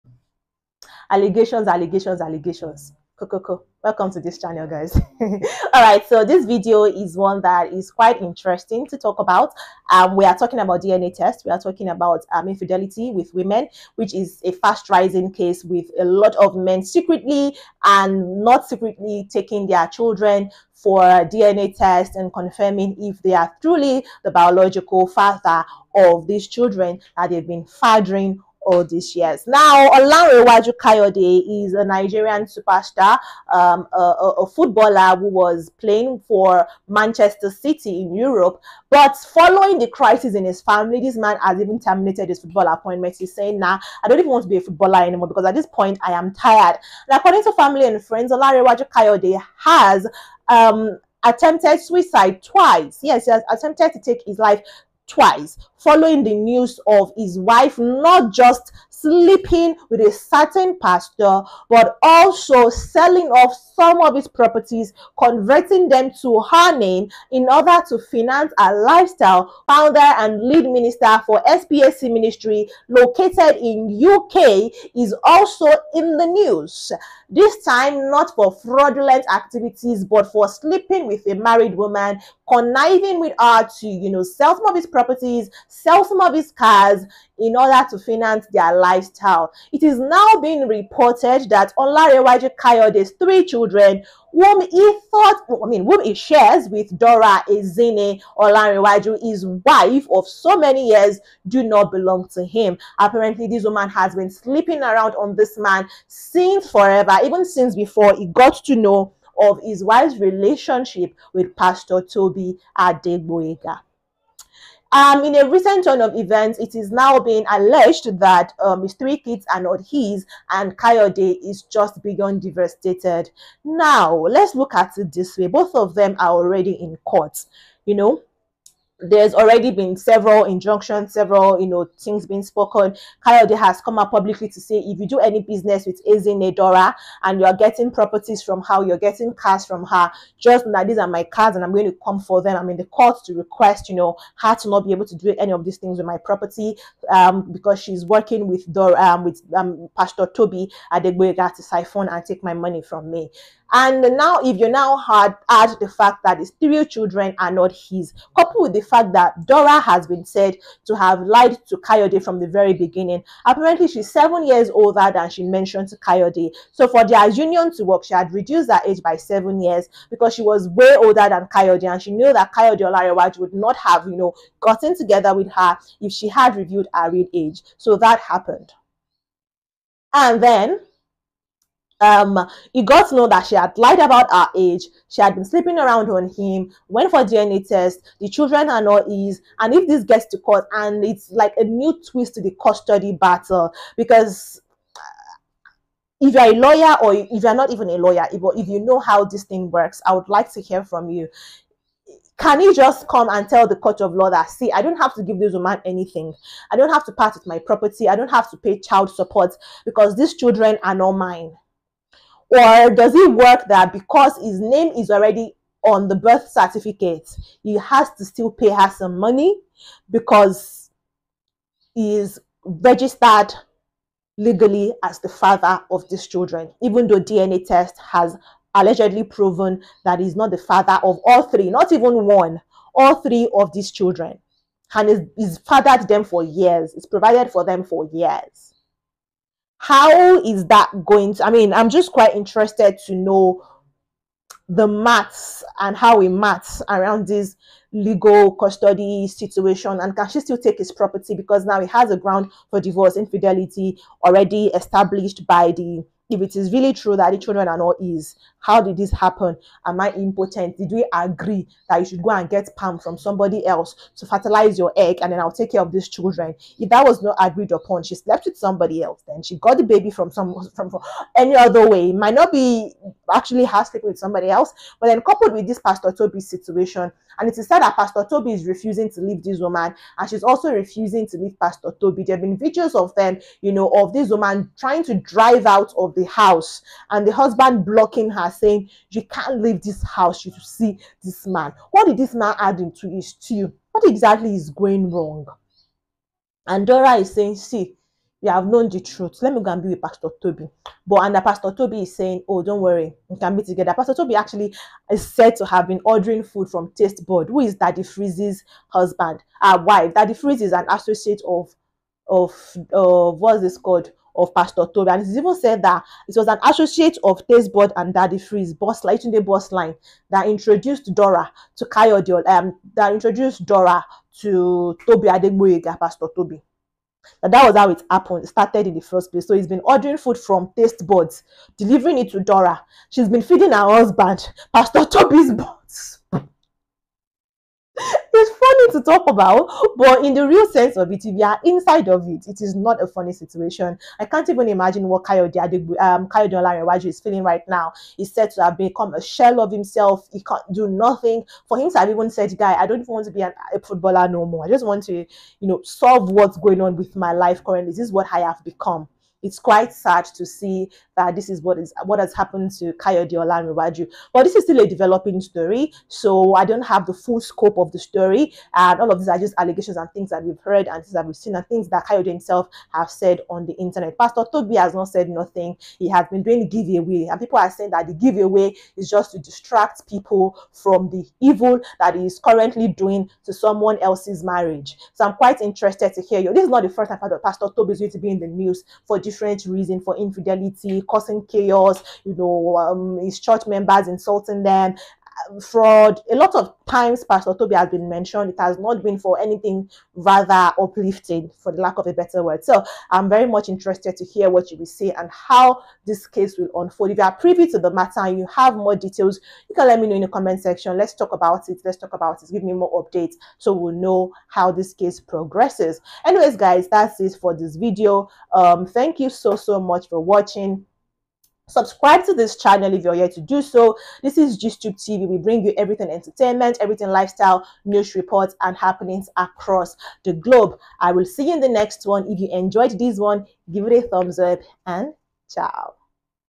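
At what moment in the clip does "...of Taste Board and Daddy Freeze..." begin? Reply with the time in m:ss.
5:17.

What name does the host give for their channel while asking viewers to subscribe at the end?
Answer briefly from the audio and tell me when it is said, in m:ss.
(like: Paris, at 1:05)
Gistube TV, at 7:04.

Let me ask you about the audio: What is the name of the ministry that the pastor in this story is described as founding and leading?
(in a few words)
SPSC Ministry.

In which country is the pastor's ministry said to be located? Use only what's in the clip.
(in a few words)
UK.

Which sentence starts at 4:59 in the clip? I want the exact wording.
Let me go and be with Pastor Tobi.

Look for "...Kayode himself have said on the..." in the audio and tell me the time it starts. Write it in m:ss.
6:12.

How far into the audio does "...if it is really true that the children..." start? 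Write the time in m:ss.
4:16.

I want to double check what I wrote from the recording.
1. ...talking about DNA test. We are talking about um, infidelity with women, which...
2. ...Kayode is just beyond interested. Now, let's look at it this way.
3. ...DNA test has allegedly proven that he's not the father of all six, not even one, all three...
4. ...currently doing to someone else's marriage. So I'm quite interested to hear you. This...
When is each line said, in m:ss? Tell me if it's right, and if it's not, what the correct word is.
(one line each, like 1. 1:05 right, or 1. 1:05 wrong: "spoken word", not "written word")
1. 0:10 right
2. 2:00 wrong: "devastated", not "interested"
3. 3:47 wrong: "three", not "six"
4. 6:22 right.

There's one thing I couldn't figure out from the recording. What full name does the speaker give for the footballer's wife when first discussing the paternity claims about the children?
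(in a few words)
Dora Ezine Olanrewaju.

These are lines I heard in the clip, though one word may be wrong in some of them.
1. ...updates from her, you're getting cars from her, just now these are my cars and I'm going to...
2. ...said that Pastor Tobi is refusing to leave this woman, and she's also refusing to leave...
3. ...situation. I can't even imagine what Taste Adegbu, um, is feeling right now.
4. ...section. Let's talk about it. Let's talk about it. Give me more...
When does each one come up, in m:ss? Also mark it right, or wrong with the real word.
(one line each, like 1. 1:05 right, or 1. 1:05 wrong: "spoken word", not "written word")
1. 2:17 wrong: "properties", not "updates"
2. 4:37 right
3. 5:43 wrong: "Kayode", not "Taste"
4. 6:50 right.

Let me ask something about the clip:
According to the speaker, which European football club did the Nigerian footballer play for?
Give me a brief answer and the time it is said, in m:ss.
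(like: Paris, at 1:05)
Manchester City, at 0:36.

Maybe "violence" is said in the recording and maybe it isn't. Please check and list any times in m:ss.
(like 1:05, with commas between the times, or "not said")
not said.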